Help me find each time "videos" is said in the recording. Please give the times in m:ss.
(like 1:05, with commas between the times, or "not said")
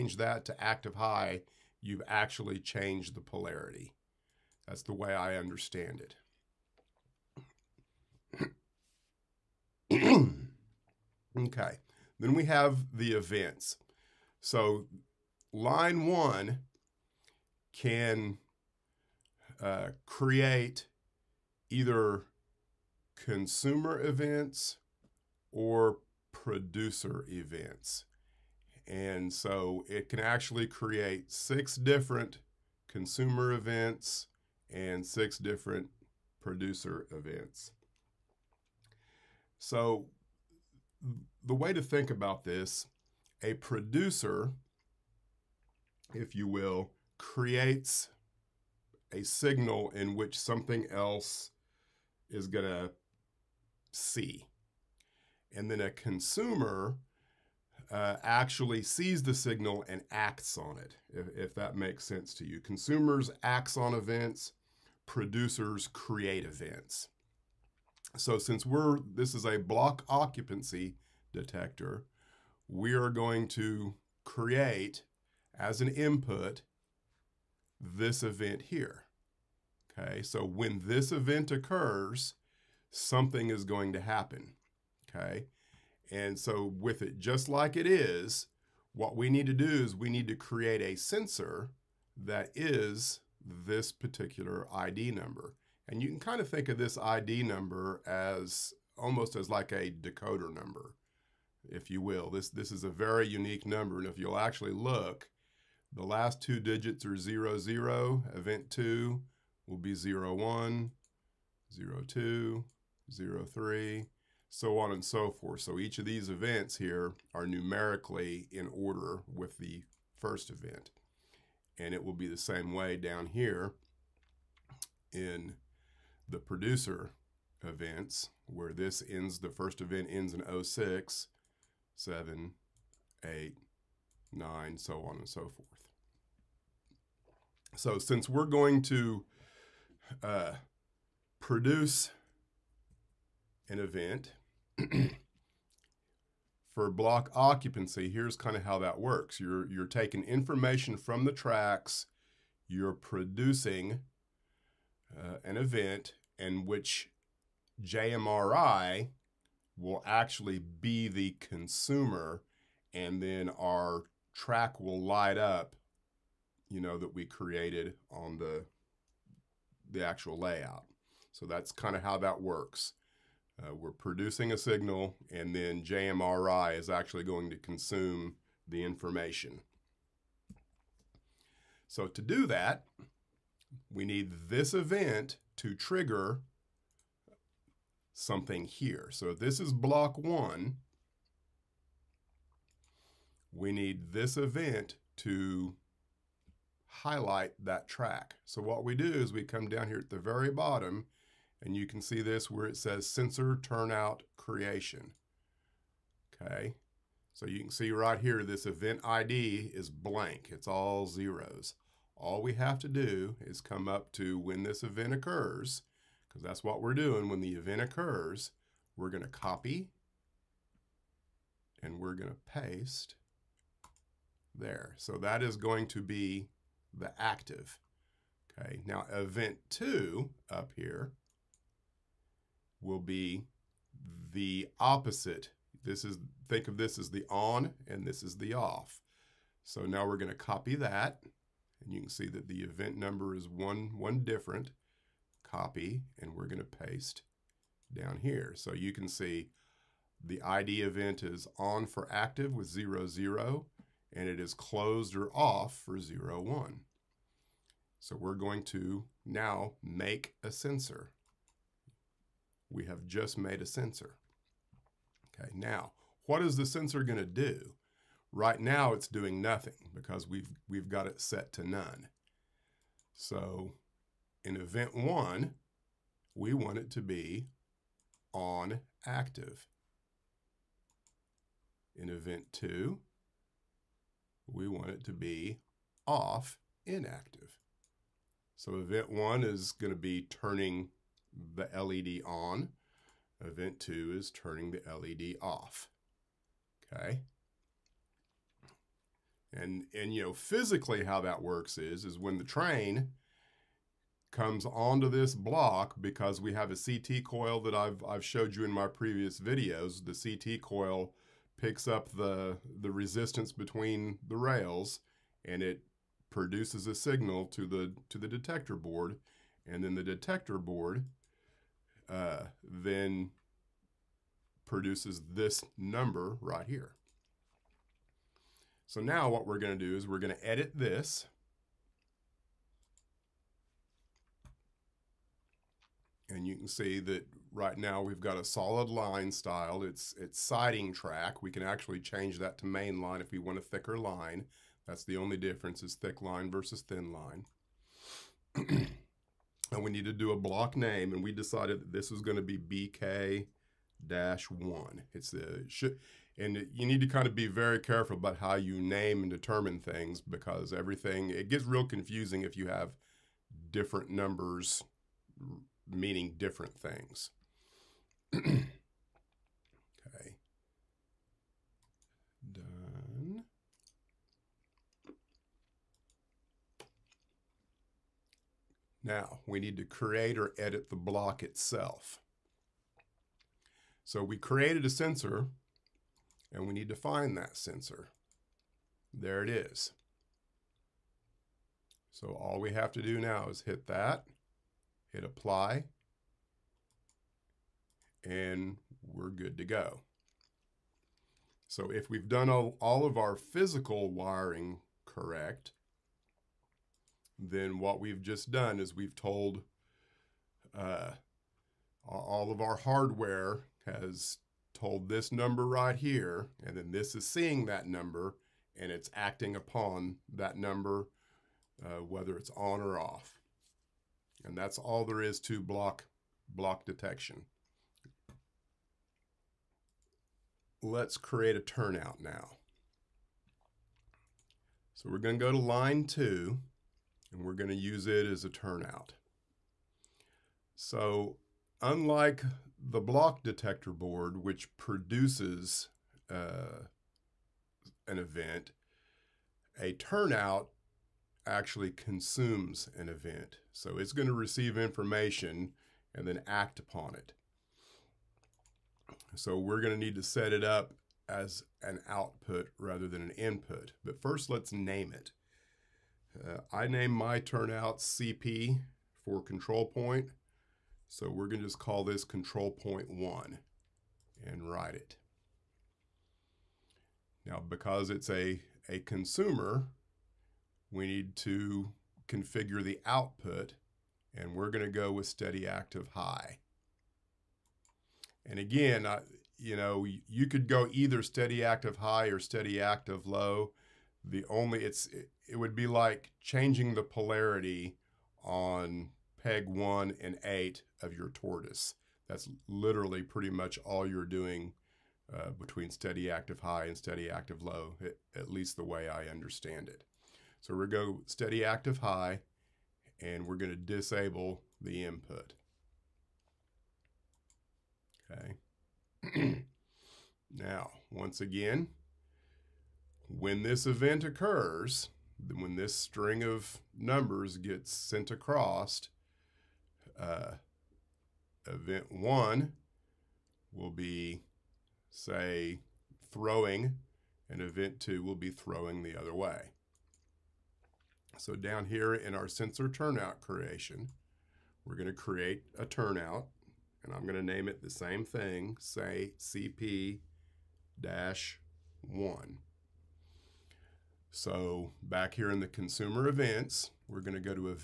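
5:09.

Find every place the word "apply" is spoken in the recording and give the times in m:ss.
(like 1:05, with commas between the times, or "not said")
6:35.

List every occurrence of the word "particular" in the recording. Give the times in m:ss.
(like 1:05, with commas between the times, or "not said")
1:33.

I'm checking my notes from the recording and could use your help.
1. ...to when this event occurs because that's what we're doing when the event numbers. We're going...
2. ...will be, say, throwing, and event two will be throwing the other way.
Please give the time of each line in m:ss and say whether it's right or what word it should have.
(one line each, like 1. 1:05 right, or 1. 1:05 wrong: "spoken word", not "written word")
1. 3:34 wrong: "occurs", not "numbers"
2. 8:53 right.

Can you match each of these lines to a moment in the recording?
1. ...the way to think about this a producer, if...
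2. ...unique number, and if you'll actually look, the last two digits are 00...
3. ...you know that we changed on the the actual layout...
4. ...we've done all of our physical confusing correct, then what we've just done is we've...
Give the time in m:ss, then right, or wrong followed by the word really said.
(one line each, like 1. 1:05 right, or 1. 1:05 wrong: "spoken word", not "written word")
1. 0:41 right
2. 1:43 right
3. 2:46 wrong: "created", not "changed"
4. 6:42 wrong: "wiring", not "confusing".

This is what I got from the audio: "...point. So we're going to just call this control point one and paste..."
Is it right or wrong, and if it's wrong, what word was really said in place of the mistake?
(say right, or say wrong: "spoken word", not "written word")
wrong: "write", not "paste".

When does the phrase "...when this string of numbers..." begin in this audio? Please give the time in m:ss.
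8:45.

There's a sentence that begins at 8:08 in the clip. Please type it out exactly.
And again, I, you know, you could go either steady active high or steady active low.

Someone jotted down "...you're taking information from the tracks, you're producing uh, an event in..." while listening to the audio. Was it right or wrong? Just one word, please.
right.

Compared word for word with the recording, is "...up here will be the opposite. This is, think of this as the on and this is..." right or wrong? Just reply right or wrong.
right.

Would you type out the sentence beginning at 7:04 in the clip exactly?
And that's all there is to block, block detection.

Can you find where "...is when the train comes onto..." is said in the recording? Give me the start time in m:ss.
5:02.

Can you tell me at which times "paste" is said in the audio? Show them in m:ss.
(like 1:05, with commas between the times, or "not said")
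3:42, 4:06.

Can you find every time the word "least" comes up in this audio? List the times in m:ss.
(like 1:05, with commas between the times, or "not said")
8:28.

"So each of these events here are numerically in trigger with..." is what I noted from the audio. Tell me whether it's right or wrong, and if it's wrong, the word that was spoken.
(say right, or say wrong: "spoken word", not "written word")
wrong: "order", not "trigger".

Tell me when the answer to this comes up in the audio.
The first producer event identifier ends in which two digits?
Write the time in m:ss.
2:10.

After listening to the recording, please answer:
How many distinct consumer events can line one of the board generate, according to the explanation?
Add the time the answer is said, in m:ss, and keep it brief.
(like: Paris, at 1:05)
6, at 0:31.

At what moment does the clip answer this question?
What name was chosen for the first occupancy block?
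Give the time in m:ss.
5:52.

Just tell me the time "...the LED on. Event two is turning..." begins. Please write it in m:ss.
4:51.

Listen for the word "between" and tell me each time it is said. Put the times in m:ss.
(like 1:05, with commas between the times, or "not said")
5:13, 8:25.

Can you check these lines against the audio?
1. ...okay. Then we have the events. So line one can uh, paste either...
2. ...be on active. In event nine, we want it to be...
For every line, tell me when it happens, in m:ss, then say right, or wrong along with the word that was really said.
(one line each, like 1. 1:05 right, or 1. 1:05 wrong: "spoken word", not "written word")
1. 0:11 wrong: "create", not "paste"
2. 4:37 wrong: "two", not "nine".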